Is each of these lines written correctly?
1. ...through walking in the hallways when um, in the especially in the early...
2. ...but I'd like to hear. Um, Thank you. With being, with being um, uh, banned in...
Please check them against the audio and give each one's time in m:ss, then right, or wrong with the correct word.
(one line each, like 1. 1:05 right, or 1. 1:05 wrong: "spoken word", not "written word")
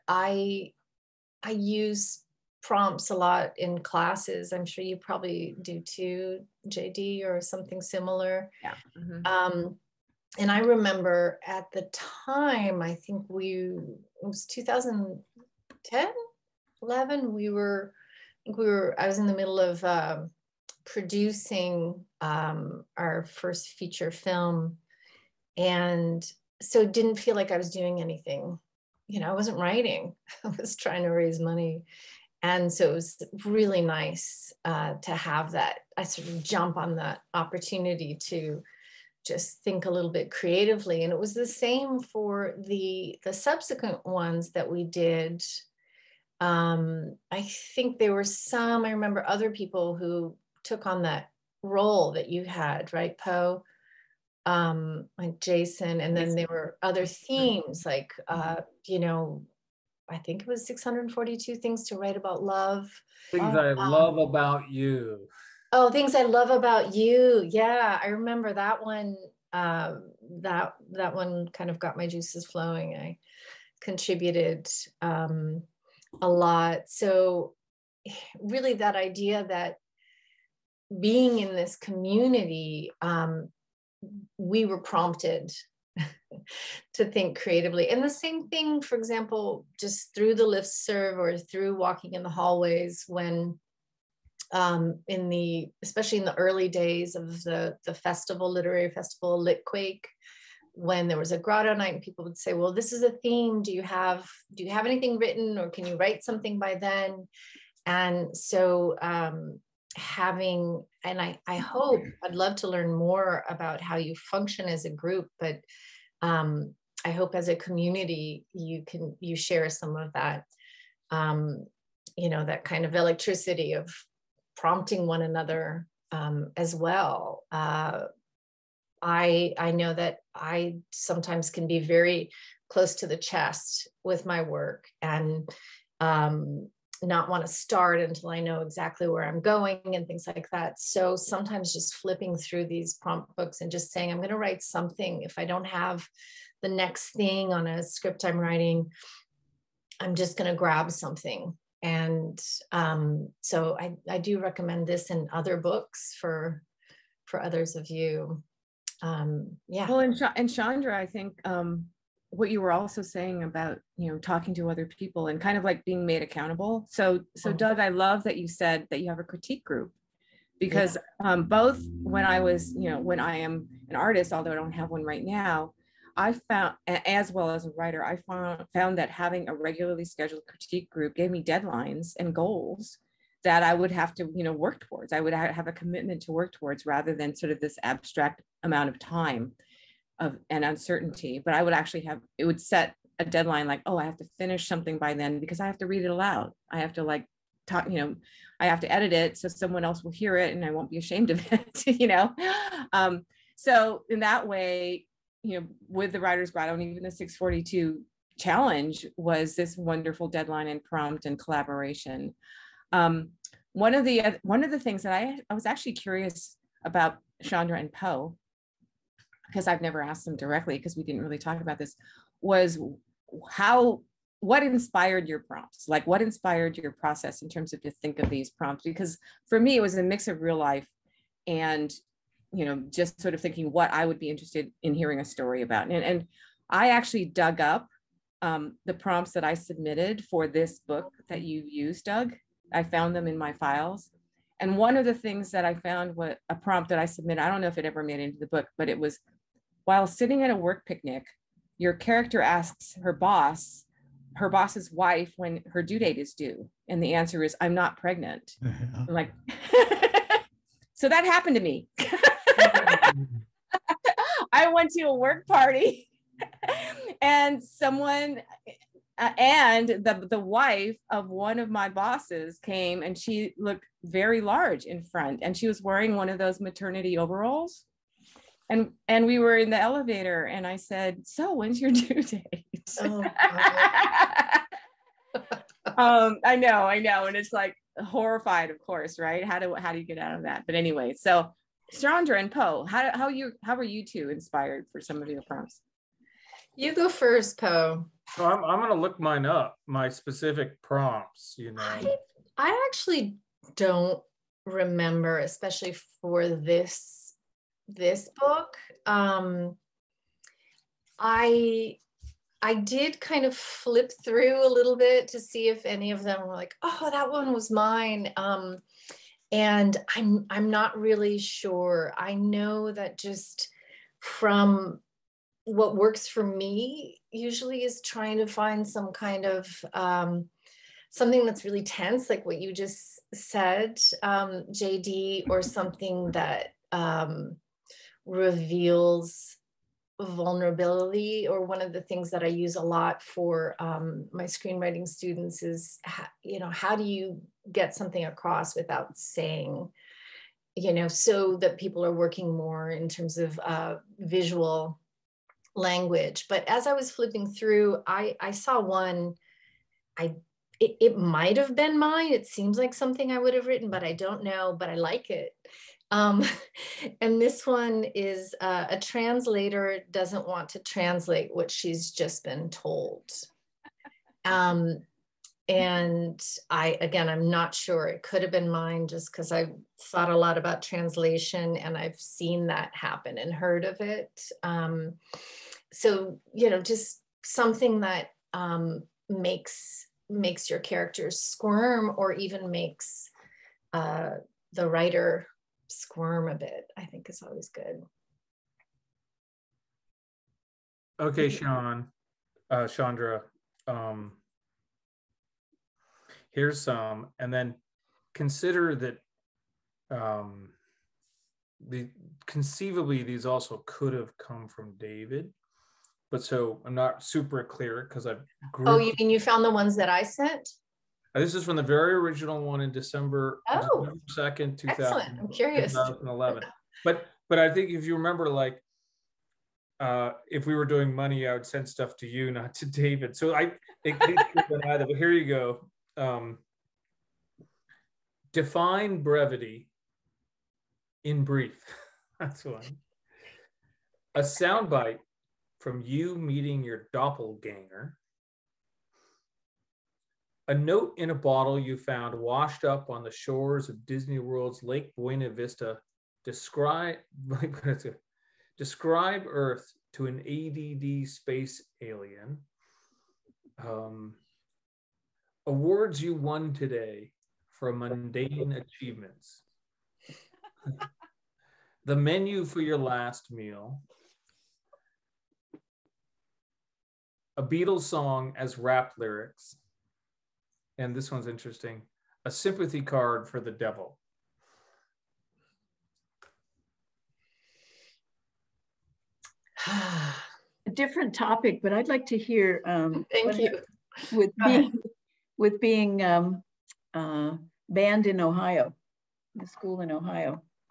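1. 1:31 right
2. 8:11 right.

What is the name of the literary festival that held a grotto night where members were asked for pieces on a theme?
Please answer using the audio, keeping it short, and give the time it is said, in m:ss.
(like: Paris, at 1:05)
Litquake, at 1:39.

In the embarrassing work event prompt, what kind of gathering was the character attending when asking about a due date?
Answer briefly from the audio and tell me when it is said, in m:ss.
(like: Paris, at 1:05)
work picnic, at 4:10.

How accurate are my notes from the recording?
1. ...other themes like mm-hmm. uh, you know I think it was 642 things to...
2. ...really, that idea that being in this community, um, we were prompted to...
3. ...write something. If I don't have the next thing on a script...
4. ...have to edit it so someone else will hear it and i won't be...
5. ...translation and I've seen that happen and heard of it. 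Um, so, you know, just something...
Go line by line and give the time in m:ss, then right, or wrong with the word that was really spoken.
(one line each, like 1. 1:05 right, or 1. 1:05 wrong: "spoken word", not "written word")
1. 0:56 right
2. 1:18 right
3. 2:24 right
4. 3:18 right
5. 6:20 right.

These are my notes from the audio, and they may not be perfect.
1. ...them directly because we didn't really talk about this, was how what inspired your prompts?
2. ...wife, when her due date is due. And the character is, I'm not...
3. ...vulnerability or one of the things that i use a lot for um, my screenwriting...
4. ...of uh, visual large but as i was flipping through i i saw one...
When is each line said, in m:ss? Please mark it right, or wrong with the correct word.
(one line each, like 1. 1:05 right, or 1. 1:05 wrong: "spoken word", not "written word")
1. 3:40 right
2. 4:14 wrong: "answer", not "character"
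3. 5:40 right
4. 5:53 wrong: "language", not "large".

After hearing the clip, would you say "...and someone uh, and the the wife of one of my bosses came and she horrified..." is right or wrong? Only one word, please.
wrong.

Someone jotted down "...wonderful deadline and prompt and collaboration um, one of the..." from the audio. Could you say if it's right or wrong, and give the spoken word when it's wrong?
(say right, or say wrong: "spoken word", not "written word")
right.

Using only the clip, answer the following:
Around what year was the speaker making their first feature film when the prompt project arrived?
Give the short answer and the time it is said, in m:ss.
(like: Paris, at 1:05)
2010, at 0:14.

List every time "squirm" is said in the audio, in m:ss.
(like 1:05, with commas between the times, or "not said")
6:31, 6:35.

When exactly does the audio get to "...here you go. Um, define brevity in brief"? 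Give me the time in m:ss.
7:15.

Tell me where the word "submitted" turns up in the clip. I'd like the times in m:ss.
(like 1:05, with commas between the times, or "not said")
3:59, 4:07.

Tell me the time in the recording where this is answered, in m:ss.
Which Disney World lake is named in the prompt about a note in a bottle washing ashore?
7:34.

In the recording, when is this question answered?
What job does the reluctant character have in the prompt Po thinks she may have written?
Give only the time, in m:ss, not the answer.
6:08.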